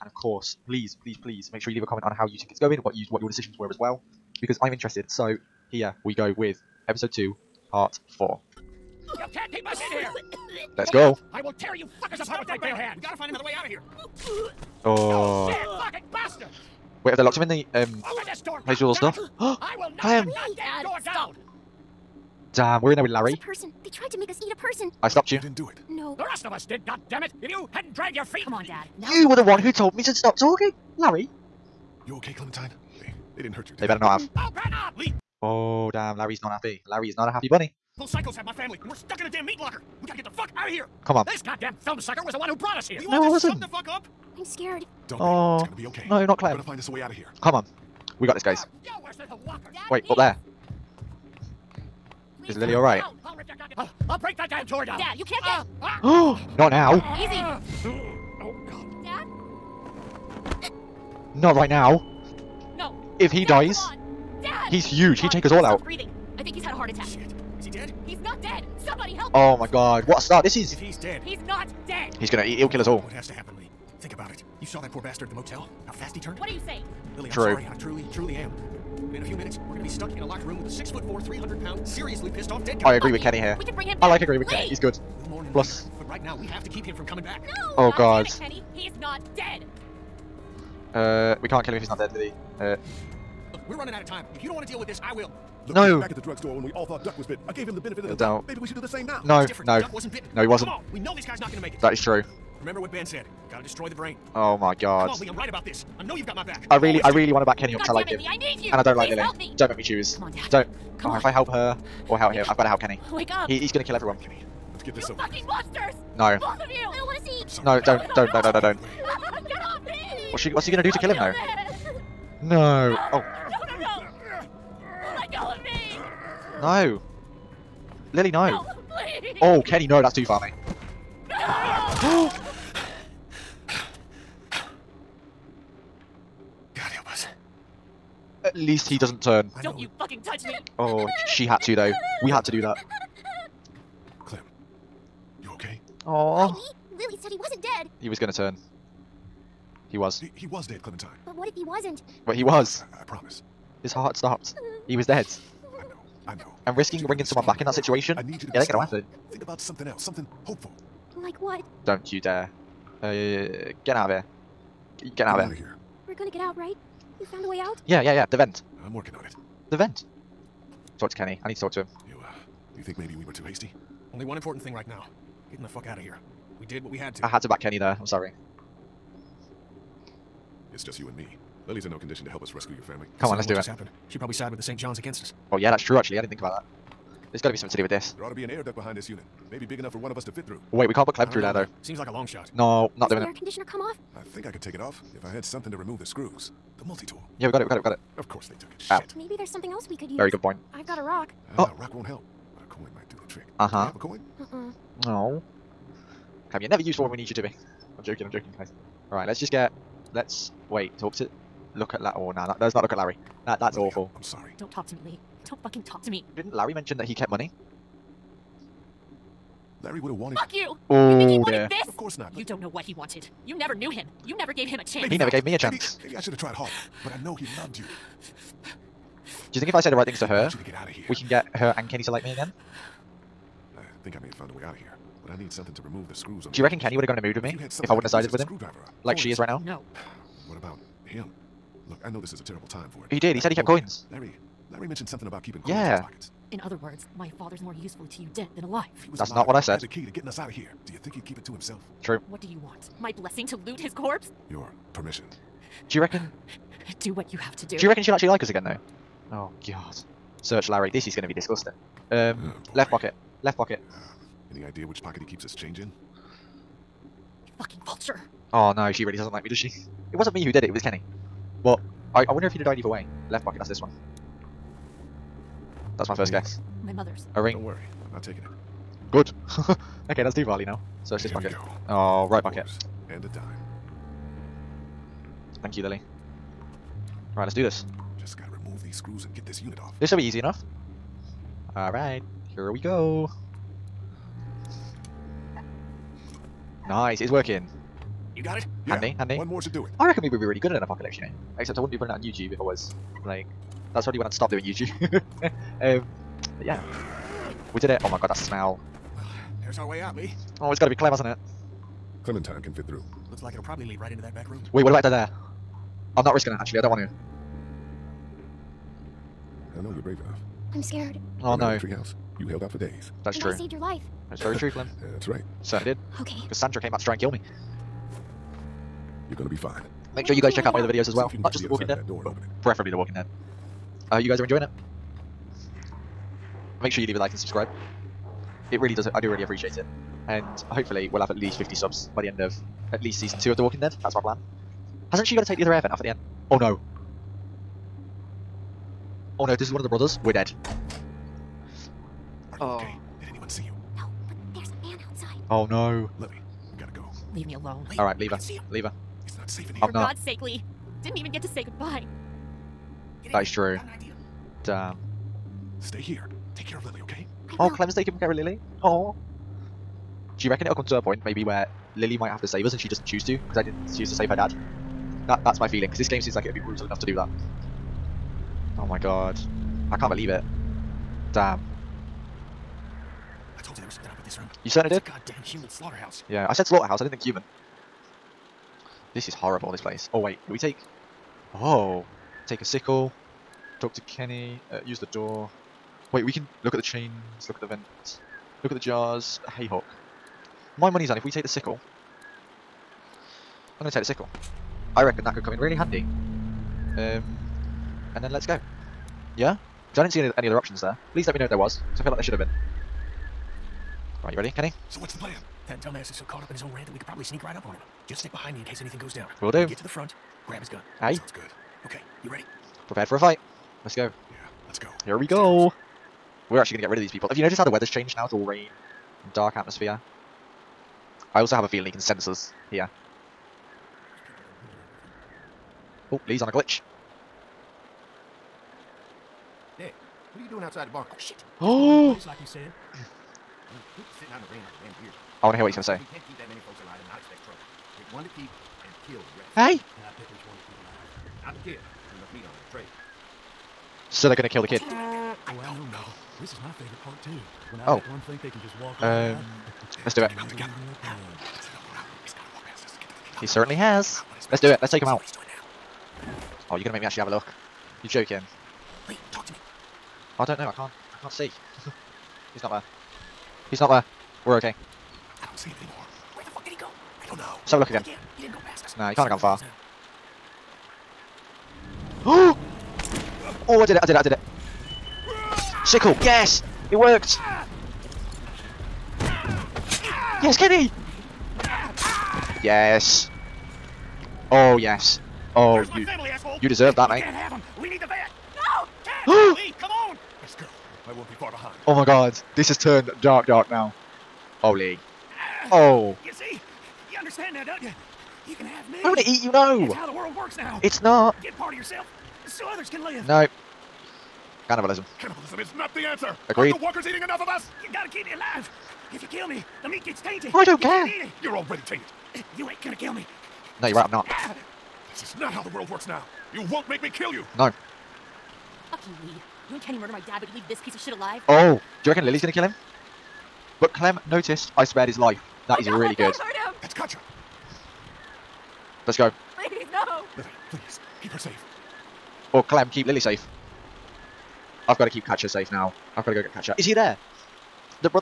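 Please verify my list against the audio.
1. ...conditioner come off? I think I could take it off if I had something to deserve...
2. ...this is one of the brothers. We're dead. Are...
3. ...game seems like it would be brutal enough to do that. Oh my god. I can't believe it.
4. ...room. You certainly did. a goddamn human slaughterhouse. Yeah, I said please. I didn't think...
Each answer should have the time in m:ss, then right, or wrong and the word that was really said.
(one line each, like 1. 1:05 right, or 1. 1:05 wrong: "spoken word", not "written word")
1. 3:13 wrong: "remove", not "deserve"
2. 5:49 right
3. 6:16 right
4. 6:24 wrong: "slaughterhouse", not "please".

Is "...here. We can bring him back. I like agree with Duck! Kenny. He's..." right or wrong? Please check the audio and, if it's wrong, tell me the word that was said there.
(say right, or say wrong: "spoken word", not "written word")
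wrong: "Lee", not "Duck".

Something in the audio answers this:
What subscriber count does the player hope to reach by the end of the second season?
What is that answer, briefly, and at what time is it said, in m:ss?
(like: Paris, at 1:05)
50, at 5:41.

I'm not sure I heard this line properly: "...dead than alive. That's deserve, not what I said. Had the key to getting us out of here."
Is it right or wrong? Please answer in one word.
wrong.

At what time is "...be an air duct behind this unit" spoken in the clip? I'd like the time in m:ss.
3:08.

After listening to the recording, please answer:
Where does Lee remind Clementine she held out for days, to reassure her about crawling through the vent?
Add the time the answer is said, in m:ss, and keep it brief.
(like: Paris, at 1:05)
The treehouse, at 5:21.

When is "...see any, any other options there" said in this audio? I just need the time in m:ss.
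6:50.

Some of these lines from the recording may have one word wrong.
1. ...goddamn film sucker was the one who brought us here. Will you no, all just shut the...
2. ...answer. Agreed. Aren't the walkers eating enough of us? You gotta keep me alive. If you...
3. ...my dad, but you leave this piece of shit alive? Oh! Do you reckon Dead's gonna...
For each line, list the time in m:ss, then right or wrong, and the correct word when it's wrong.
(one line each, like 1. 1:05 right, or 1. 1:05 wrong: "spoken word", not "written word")
1. 0:41 right
2. 8:36 right
3. 8:50 wrong: "Lily", not "Dead".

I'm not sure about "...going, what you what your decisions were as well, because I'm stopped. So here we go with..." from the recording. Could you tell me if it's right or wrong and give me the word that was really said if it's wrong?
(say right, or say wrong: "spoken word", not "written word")
wrong: "interested", not "stopped".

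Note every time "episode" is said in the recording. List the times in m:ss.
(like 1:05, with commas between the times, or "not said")
0:06.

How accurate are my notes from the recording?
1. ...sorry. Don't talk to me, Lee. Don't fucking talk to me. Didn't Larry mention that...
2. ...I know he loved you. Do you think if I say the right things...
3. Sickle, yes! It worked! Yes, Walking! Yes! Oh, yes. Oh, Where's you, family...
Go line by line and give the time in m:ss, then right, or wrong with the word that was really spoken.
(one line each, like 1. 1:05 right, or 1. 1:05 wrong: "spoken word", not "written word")
1. 3:34 right
2. 3:47 right
3. 8:05 wrong: "Kenny", not "Walking".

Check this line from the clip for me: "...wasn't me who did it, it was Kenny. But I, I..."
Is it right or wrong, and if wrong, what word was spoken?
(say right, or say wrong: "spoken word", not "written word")
right.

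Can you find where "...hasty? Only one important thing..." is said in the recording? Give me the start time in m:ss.
2:53.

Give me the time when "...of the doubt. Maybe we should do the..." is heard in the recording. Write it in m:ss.
1:38.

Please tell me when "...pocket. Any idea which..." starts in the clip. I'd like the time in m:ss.
4:23.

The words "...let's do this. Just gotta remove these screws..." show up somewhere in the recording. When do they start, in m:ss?
4:47.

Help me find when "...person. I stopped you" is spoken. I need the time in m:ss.
0:24.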